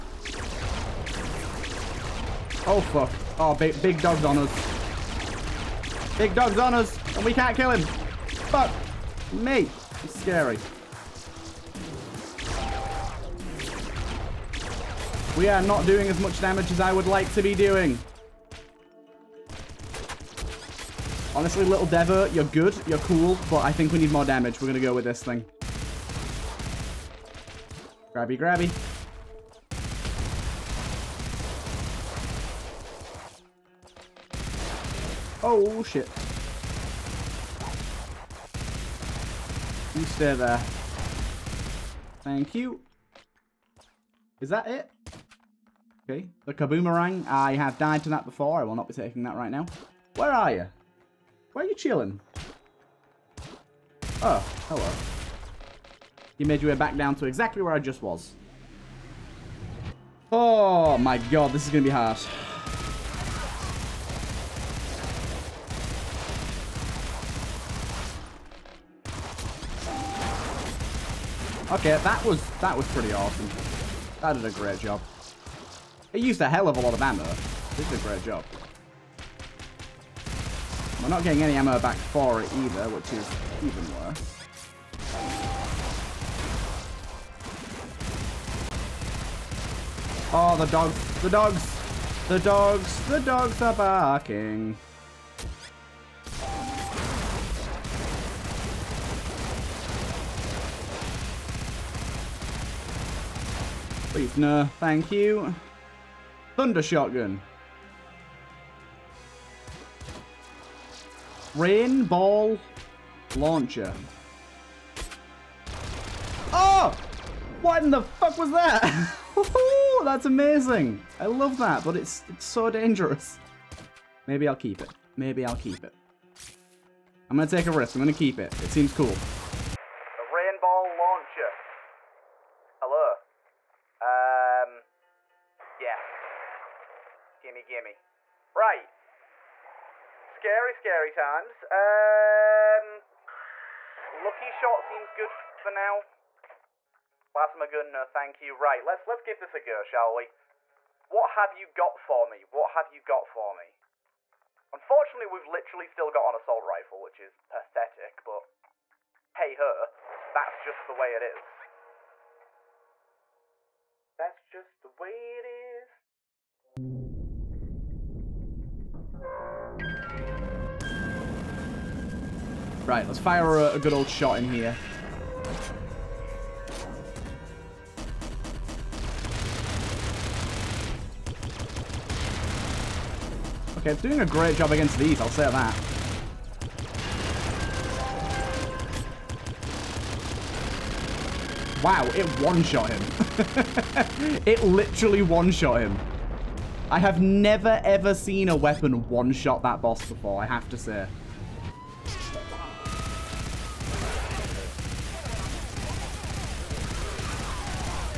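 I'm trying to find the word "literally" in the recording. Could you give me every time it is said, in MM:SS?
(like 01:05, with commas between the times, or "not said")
02:35, 03:14.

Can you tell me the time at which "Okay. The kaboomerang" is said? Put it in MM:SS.
00:46.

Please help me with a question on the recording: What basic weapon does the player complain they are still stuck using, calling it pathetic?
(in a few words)
Assault rifle.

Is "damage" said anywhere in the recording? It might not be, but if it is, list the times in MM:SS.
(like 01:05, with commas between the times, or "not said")
00:16, 00:24.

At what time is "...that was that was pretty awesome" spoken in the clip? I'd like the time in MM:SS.
01:12.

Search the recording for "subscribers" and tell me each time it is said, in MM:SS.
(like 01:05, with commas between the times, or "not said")
not said.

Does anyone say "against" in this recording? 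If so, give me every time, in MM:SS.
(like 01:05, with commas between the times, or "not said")
03:04.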